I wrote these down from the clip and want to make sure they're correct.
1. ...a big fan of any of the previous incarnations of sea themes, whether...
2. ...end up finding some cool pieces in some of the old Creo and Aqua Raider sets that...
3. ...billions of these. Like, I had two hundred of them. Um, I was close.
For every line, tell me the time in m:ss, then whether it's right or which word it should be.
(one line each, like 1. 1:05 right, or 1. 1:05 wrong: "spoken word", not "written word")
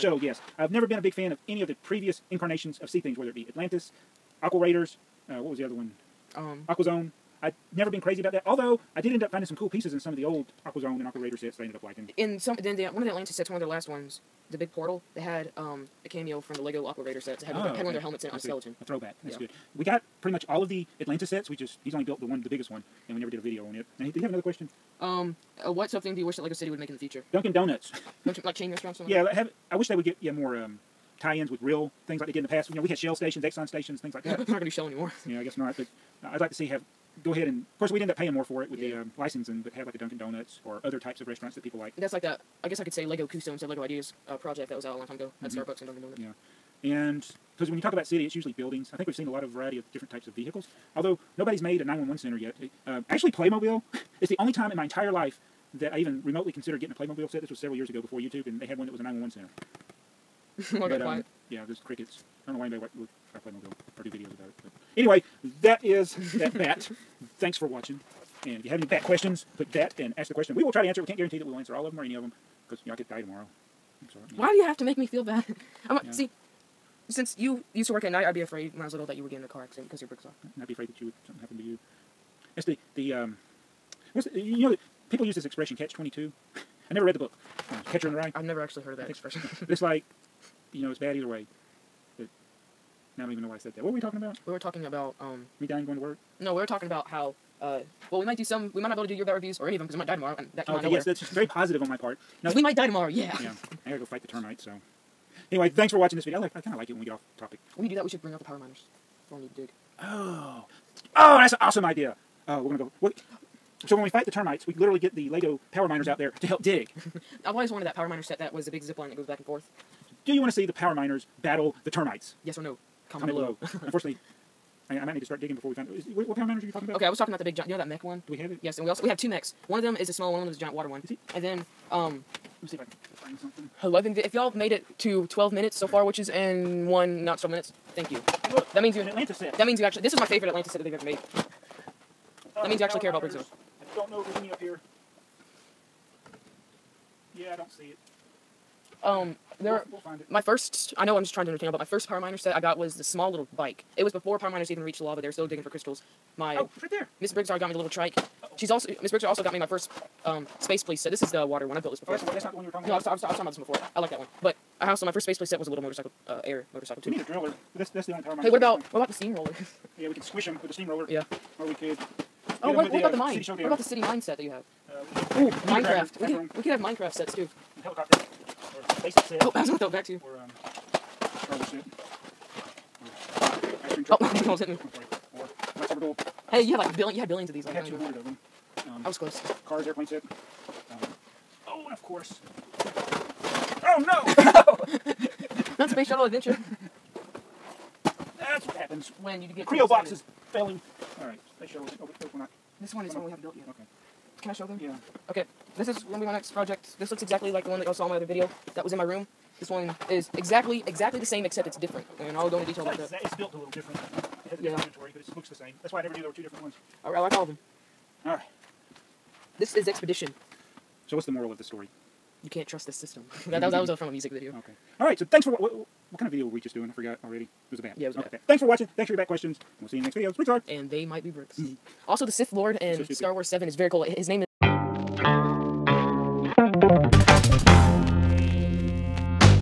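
1. 0:00 right
2. 0:09 wrong: "AquaZone", not "Creo"
3. 3:07 right.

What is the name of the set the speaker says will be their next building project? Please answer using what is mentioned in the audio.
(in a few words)
Expedition.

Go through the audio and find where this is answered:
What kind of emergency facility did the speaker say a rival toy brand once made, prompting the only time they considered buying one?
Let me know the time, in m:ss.
0:58.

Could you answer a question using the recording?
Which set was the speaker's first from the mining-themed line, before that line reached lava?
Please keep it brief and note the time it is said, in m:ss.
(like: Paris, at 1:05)
the little trike, at 2:37.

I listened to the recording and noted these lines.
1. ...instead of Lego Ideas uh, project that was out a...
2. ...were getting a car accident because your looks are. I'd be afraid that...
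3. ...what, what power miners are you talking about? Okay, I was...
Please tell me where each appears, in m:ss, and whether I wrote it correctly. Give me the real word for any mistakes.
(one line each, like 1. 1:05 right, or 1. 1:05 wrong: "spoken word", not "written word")
1. 0:43 right
2. 1:19 wrong: "bricks", not "looks"
3. 2:06 right.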